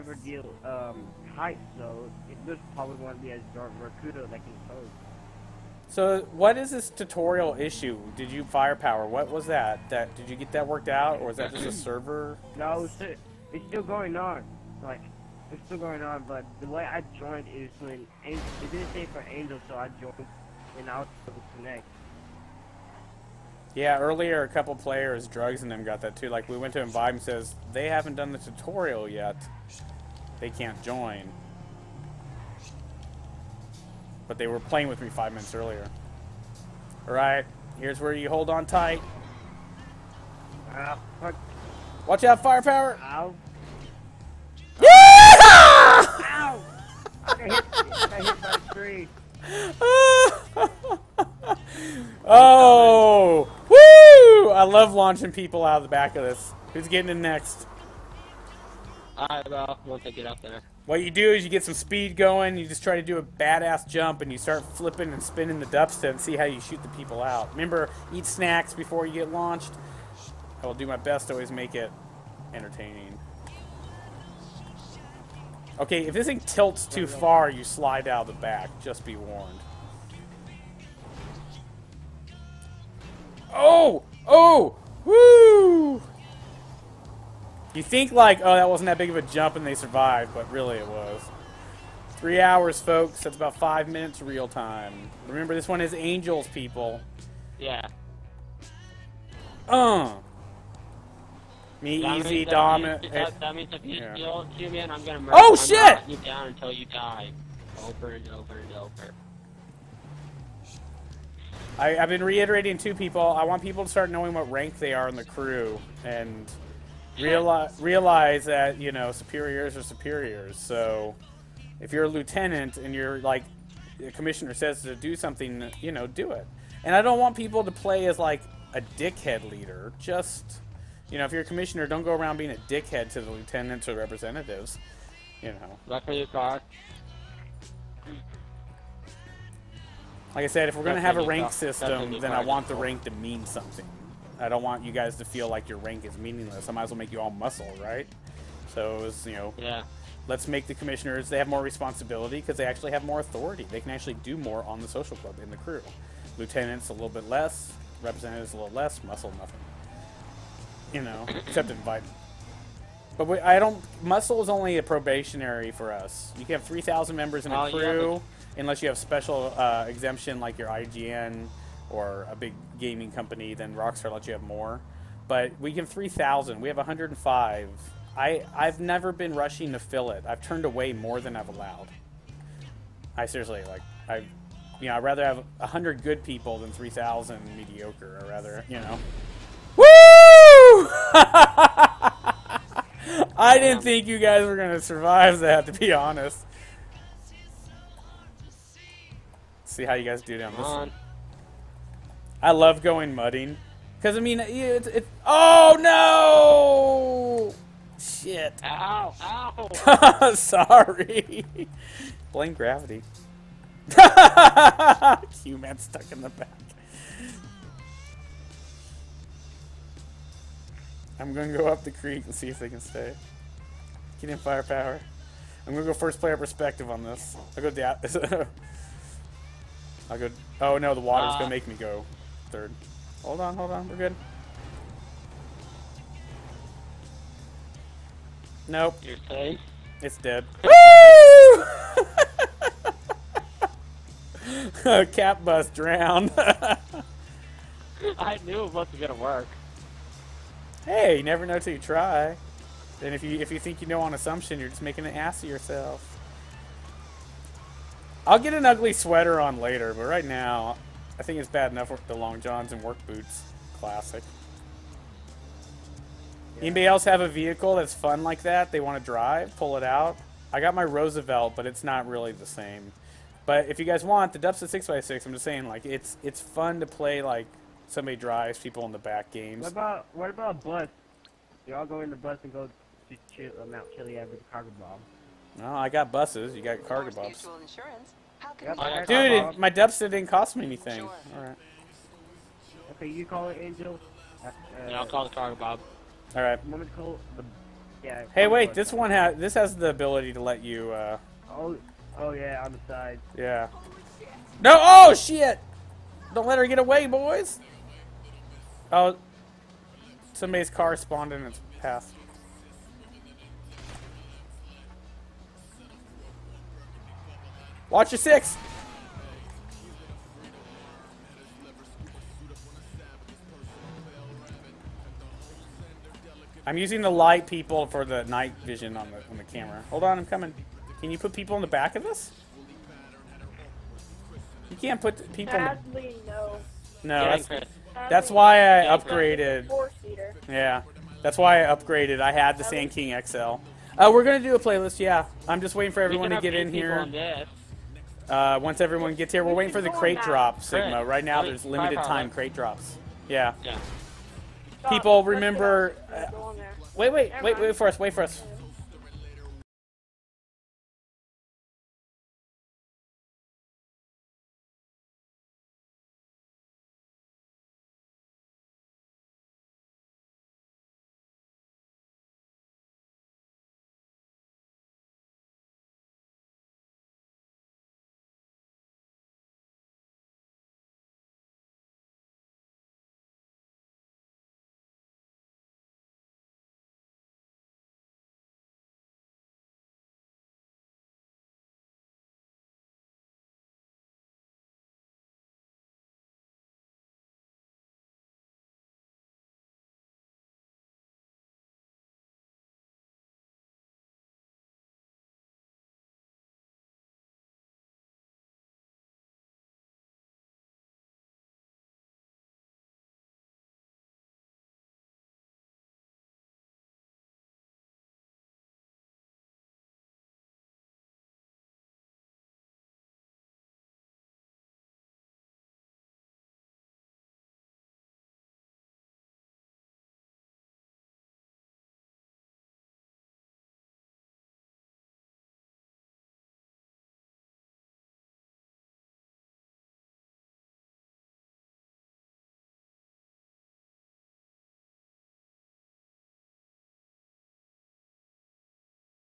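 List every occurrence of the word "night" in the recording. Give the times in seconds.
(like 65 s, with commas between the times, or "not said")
328 s.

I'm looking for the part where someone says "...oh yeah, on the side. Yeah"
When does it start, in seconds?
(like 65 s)
302 s.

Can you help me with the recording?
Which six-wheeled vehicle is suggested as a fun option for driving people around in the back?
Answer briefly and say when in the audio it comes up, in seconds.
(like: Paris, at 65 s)
Dubs 6x6, at 274 s.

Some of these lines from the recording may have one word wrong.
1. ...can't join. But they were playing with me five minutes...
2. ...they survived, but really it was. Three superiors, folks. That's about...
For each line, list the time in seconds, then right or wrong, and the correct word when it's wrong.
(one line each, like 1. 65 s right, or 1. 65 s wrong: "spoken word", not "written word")
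1. 30 s right
2. 89 s wrong: "hours", not "superiors".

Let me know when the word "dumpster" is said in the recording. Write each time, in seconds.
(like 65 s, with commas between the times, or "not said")
65 s, 289 s.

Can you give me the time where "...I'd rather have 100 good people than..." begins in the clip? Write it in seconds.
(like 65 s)
184 s.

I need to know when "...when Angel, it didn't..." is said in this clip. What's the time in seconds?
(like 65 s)
17 s.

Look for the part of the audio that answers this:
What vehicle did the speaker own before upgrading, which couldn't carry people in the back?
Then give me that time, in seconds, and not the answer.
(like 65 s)
342 s.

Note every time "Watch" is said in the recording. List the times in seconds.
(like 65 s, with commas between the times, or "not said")
42 s, 317 s.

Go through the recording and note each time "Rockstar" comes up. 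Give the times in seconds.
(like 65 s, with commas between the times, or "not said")
173 s.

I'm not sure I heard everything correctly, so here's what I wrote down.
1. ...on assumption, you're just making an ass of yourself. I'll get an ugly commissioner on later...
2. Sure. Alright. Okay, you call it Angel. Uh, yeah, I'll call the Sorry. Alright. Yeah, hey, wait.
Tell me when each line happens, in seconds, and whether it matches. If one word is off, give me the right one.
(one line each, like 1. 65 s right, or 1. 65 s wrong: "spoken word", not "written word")
1. 254 s wrong: "sweater", not "commissioner"
2. 291 s wrong: "Cargobob", not "Sorry".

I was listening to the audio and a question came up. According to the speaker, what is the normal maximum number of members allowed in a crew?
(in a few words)
3,000.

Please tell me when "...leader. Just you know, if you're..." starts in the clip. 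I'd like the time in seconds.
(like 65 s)
129 s.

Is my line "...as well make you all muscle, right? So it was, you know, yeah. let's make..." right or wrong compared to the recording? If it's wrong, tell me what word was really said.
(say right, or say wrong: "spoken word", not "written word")
right.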